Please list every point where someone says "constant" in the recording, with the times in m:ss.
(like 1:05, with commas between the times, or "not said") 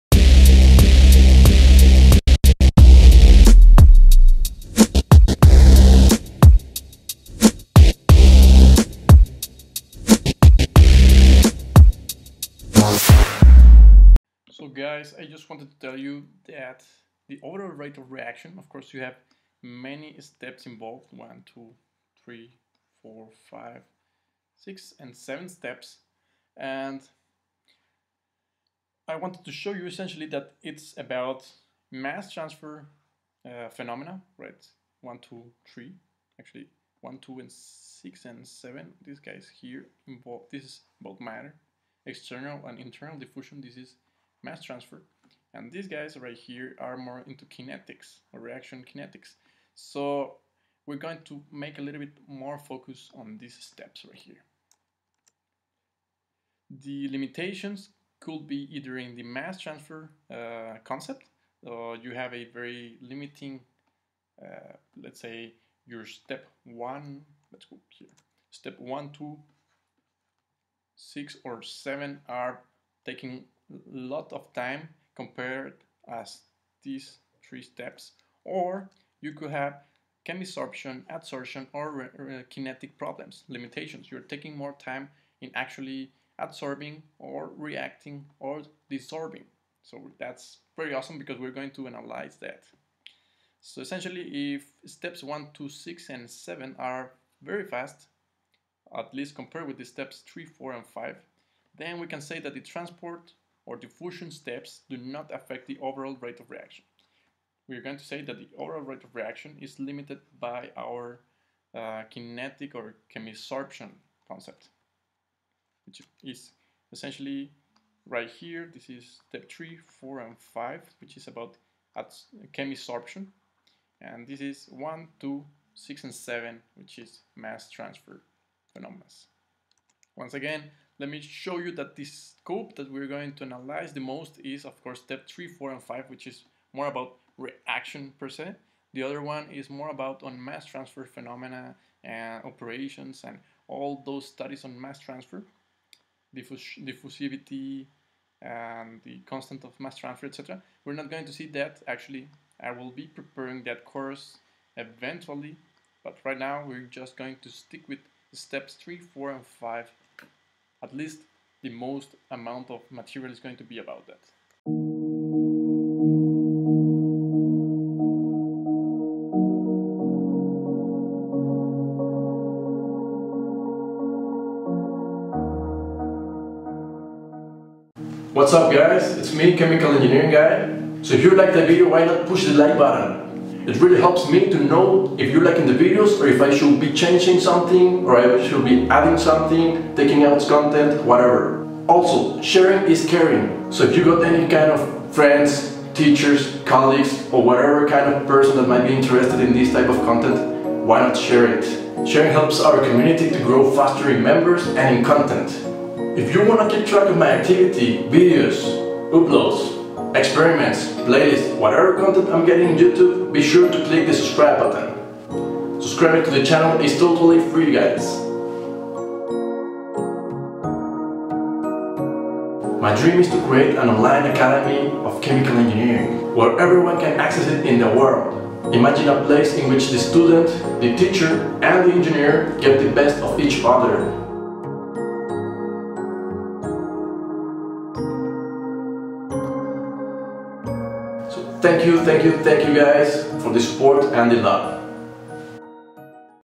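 2:29.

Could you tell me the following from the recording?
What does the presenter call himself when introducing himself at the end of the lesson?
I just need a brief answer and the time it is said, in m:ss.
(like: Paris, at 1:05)
Chemical Engineering Guy, at 2:59.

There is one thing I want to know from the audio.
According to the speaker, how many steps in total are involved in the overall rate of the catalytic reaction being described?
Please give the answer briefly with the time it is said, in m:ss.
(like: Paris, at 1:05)
7, at 0:25.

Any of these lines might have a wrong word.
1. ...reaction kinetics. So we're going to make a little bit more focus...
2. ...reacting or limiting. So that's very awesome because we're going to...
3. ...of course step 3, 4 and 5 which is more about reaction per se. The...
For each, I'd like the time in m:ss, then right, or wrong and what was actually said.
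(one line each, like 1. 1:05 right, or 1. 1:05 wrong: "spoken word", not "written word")
1. 0:48 right
2. 1:27 wrong: "desorbing", not "limiting"
3. 2:14 right.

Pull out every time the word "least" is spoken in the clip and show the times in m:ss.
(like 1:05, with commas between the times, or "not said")
1:39, 2:40.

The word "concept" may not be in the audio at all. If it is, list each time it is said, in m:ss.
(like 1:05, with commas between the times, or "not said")
1:00, 1:54.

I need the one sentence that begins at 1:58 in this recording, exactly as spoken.
This is step 3, 4, and 5, which is about chemisorption.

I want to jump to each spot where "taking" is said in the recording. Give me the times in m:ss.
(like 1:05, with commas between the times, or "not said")
1:13, 1:24, 3:09.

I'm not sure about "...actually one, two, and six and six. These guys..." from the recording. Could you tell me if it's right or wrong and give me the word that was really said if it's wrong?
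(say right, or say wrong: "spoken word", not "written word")
wrong: "seven", not "six".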